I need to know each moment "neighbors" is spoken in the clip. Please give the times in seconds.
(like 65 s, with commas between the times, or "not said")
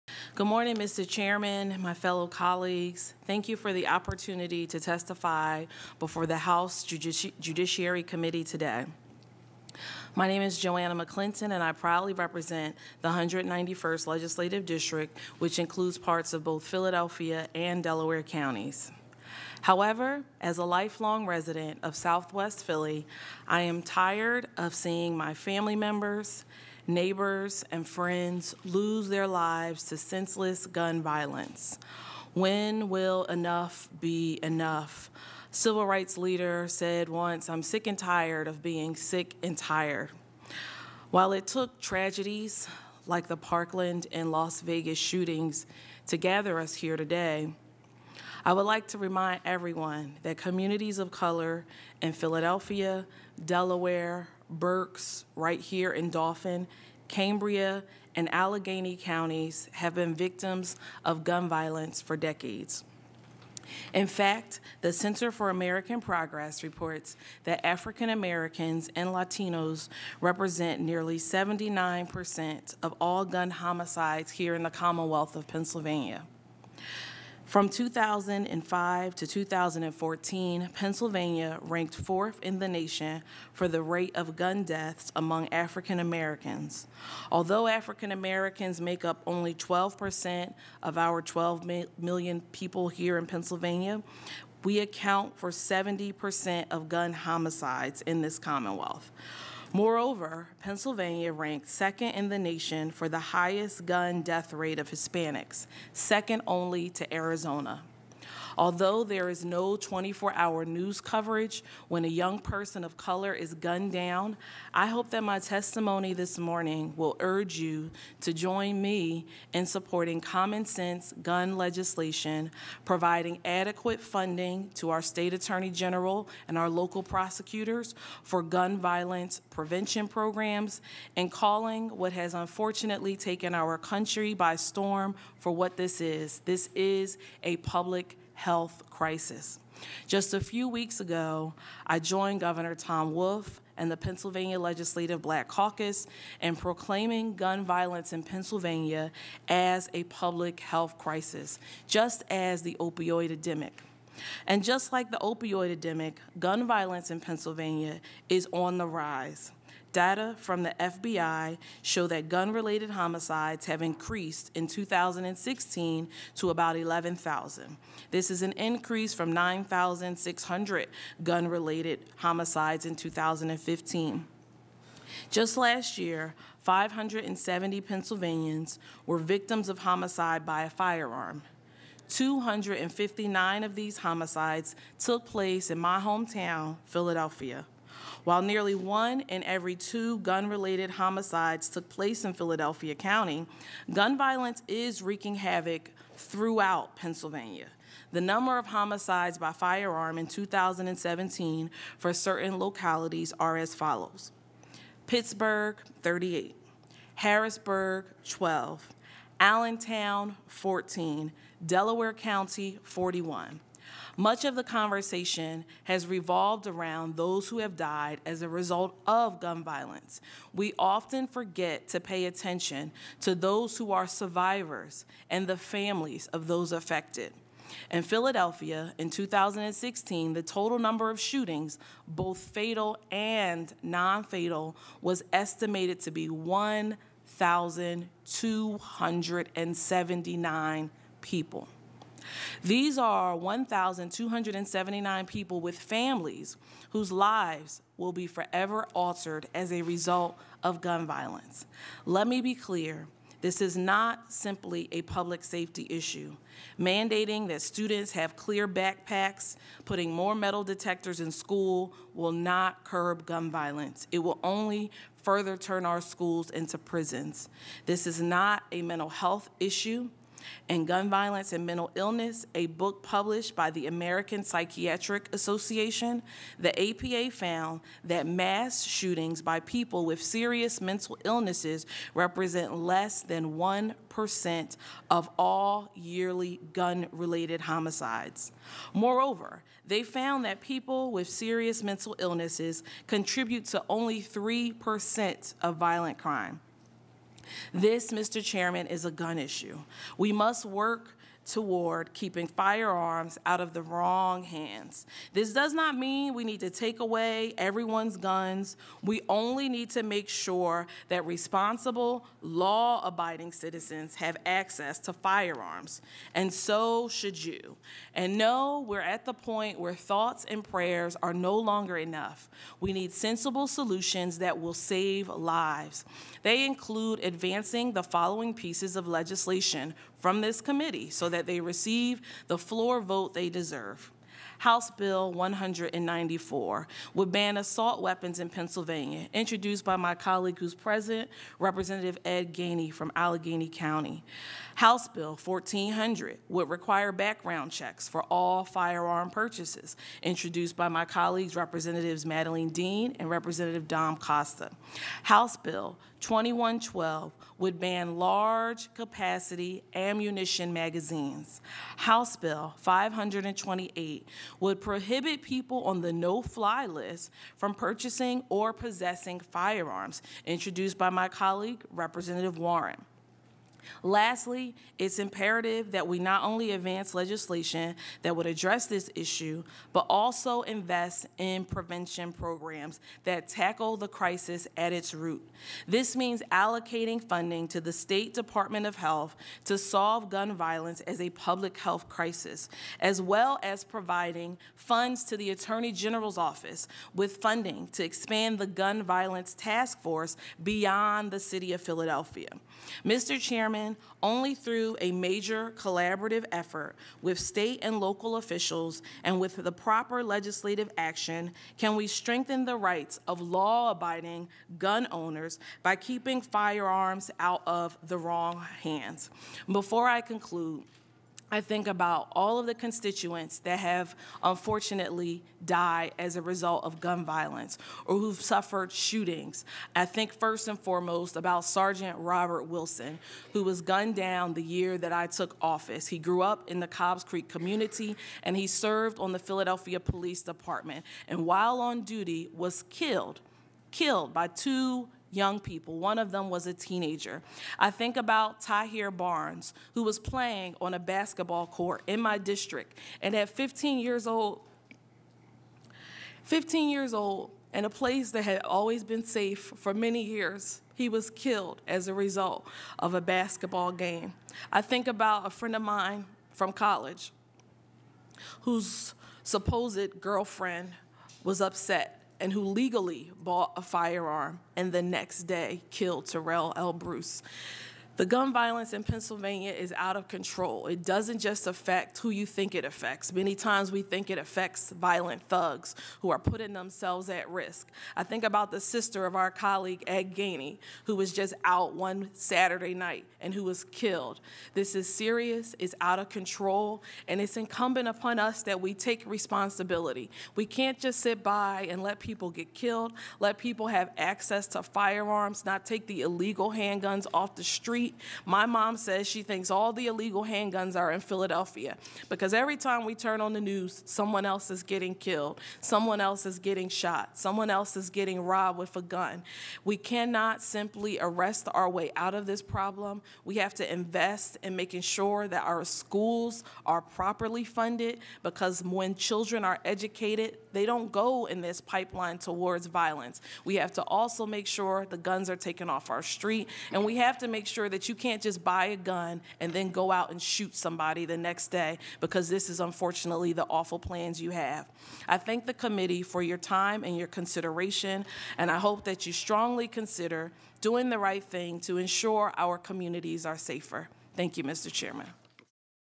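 26 s.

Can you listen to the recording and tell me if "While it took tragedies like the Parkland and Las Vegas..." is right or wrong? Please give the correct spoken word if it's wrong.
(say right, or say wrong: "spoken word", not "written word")
right.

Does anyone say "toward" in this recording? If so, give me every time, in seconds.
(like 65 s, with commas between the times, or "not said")
301 s, 532 s.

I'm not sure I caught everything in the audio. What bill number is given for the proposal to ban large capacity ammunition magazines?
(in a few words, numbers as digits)
House Bill 2112.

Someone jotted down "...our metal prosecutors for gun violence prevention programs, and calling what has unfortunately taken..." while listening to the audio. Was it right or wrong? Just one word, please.
wrong.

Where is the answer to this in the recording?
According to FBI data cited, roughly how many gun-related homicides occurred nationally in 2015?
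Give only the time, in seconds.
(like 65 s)
169 s.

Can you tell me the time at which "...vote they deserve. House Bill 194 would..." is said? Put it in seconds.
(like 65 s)
333 s.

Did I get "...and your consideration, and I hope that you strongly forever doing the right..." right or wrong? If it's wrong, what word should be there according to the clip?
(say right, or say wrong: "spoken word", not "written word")
wrong: "consider", not "forever".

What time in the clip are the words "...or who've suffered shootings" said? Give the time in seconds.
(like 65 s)
428 s.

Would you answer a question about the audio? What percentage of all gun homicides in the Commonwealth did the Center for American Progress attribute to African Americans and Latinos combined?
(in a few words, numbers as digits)
79%.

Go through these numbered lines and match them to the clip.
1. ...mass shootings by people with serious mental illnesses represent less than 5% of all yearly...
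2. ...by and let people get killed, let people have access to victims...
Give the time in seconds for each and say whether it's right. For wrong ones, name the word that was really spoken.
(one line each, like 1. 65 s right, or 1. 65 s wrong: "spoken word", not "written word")
1. 278 s wrong: "1", not "5"
2. 501 s wrong: "firearms", not "victims".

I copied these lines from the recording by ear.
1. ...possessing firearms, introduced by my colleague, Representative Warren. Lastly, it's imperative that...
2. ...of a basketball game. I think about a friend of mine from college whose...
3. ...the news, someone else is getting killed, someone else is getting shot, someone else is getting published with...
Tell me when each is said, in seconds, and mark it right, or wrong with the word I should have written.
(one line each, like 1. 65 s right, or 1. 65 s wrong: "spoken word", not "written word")
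1. 368 s right
2. 462 s right
3. 513 s wrong: "robbed", not "published".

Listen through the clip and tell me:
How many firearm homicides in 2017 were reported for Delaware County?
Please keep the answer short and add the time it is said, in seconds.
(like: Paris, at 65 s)
41, at 212 s.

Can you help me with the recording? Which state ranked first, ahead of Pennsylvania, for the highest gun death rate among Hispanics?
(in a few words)
Arizona.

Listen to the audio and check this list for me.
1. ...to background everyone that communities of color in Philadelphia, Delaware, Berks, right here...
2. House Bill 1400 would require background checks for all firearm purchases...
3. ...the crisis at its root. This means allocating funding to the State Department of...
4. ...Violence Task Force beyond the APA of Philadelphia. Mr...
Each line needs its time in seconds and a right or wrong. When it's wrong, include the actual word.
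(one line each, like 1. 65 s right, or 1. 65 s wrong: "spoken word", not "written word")
1. 48 s wrong: "remind", not "background"
2. 344 s right
3. 383 s right
4. 399 s wrong: "City", not "APA".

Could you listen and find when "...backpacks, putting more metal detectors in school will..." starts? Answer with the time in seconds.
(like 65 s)
258 s.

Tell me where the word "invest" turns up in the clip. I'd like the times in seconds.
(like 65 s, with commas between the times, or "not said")
380 s, 523 s.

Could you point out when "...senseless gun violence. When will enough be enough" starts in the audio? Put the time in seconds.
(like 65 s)
29 s.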